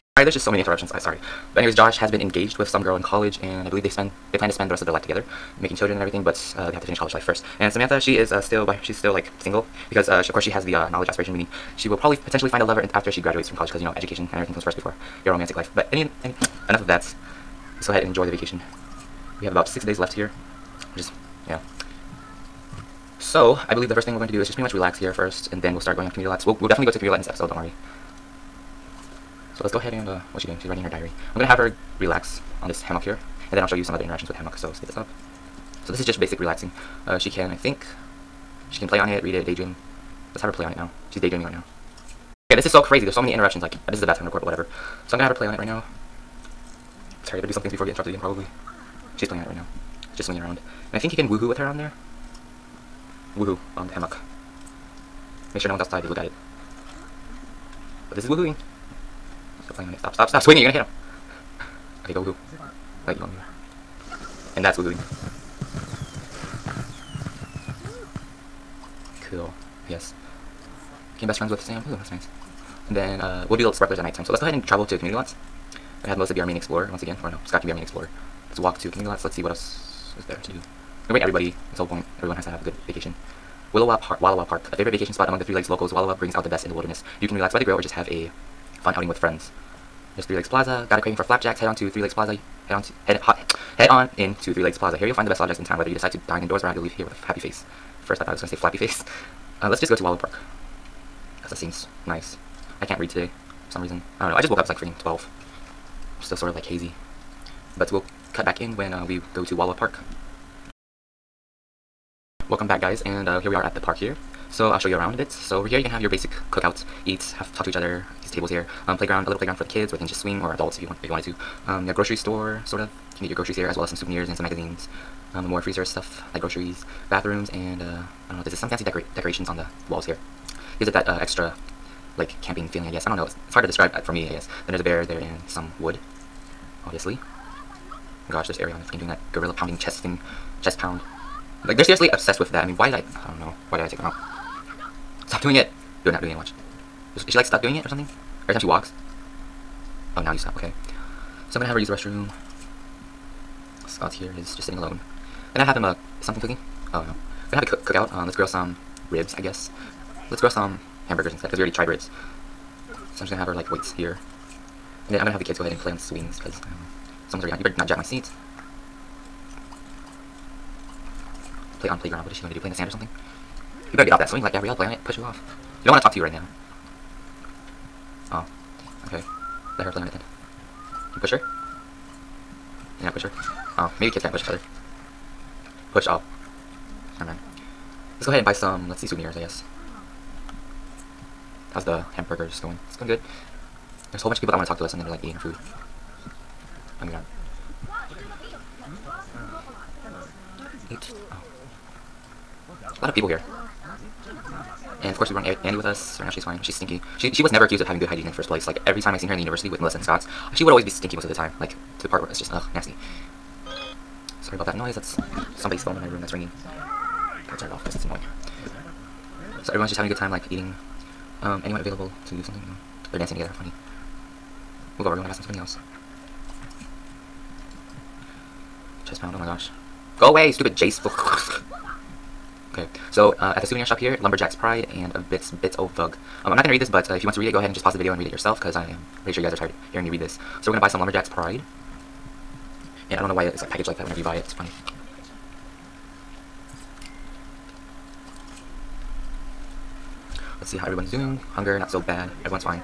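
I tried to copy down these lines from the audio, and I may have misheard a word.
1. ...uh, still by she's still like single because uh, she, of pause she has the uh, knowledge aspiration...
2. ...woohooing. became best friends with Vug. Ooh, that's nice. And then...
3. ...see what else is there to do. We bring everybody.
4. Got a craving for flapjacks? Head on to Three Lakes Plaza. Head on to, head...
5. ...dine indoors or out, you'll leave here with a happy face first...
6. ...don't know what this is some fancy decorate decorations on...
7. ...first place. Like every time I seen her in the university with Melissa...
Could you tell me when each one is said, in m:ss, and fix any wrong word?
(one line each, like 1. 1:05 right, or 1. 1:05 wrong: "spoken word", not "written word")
1. 0:08 wrong: "course", not "pause"
2. 1:04 wrong: "Sam", not "Vug"
3. 1:19 right
4. 1:30 right
5. 1:36 right
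6. 2:08 right
7. 3:28 right.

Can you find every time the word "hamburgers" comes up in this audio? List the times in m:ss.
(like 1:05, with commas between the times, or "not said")
2:41, 3:12.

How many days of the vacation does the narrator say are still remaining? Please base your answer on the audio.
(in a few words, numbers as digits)
6.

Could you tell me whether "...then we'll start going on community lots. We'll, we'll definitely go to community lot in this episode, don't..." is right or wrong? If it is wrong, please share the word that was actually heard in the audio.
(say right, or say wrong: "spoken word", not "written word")
right.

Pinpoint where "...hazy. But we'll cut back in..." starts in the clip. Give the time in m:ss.
1:46.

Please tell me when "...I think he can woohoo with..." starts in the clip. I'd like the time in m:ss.
0:50.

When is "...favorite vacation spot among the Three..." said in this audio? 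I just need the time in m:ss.
1:24.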